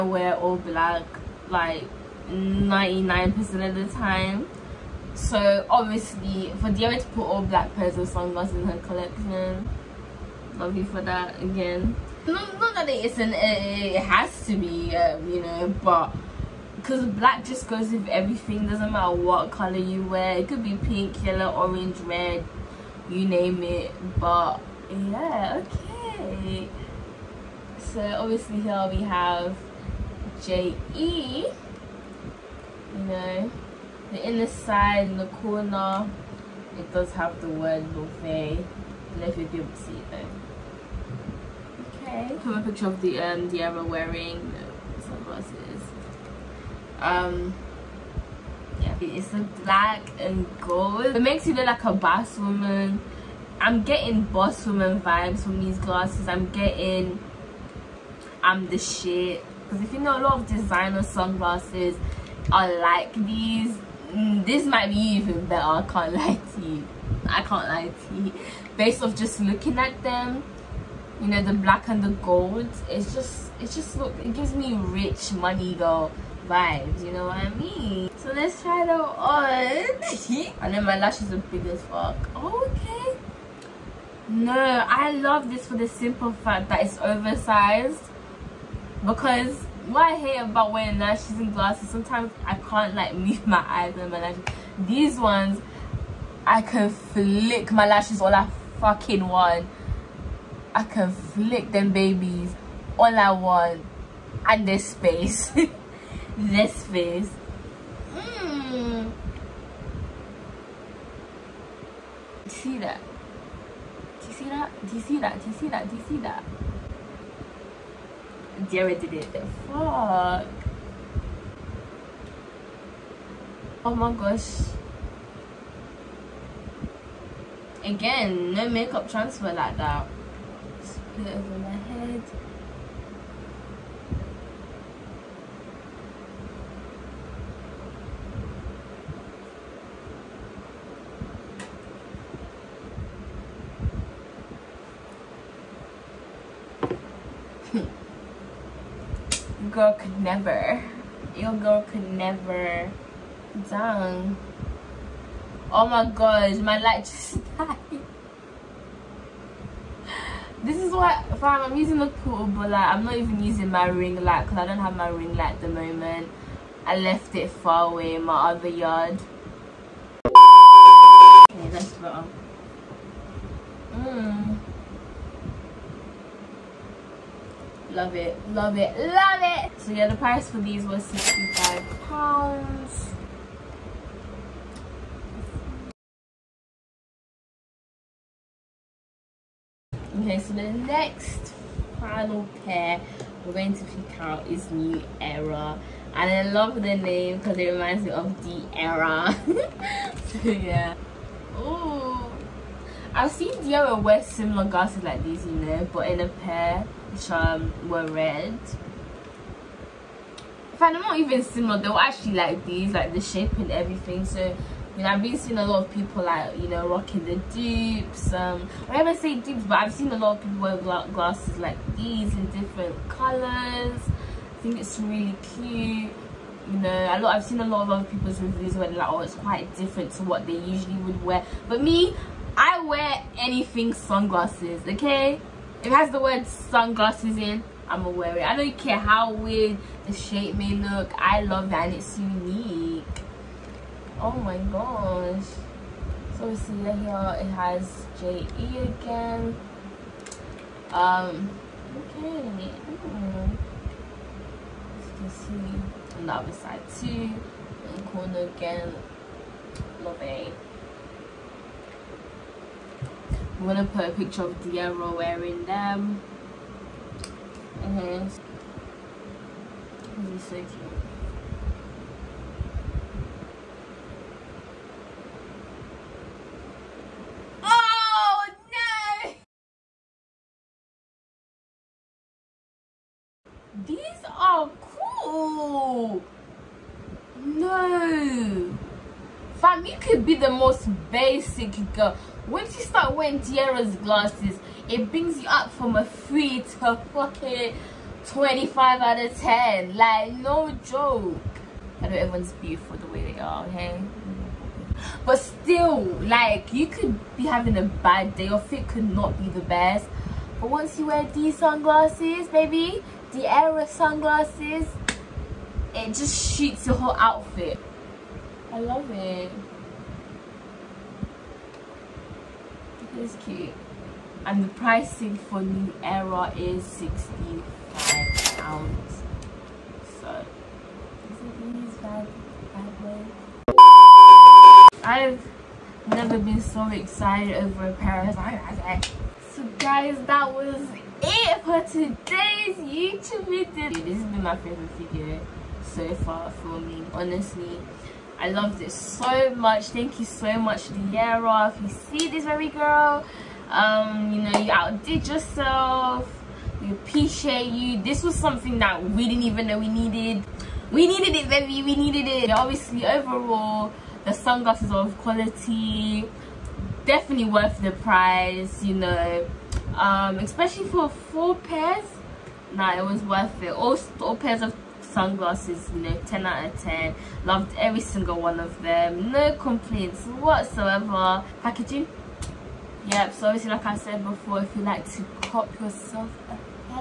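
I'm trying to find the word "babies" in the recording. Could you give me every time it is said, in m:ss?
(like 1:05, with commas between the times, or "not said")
1:41.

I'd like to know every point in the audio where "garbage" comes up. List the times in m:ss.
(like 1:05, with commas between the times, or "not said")
not said.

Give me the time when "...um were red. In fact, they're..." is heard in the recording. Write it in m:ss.
3:27.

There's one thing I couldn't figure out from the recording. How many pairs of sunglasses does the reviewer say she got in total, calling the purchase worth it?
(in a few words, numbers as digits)
4.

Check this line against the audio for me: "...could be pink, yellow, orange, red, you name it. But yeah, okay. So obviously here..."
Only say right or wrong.
right.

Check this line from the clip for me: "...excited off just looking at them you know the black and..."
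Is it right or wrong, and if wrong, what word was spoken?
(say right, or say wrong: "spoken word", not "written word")
wrong: "based", not "excited".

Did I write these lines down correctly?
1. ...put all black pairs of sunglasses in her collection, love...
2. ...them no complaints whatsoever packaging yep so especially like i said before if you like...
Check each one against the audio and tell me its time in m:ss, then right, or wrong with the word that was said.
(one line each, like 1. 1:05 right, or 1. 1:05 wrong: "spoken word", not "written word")
1. 0:07 right
2. 6:18 wrong: "obviously", not "especially".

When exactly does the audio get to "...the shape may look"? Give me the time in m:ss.
4:00.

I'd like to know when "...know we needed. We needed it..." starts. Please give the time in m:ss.
5:59.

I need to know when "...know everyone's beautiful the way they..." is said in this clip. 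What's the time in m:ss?
5:02.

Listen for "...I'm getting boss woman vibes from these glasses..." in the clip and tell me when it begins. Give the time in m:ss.
0:53.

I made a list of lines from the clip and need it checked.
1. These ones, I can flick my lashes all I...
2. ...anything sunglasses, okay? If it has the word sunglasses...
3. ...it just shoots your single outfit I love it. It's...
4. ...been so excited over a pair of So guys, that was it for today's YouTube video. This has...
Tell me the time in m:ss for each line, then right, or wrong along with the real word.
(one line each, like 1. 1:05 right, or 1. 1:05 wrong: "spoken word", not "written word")
1. 1:34 right
2. 3:53 right
3. 5:15 wrong: "whole", not "single"
4. 5:36 right.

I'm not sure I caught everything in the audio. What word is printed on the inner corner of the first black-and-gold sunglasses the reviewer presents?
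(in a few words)
buffet.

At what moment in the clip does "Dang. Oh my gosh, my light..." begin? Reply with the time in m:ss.
2:33.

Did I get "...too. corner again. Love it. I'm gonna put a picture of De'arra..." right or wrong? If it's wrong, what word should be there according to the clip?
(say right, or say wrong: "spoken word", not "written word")
right.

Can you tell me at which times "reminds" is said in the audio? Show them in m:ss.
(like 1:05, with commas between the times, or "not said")
3:17.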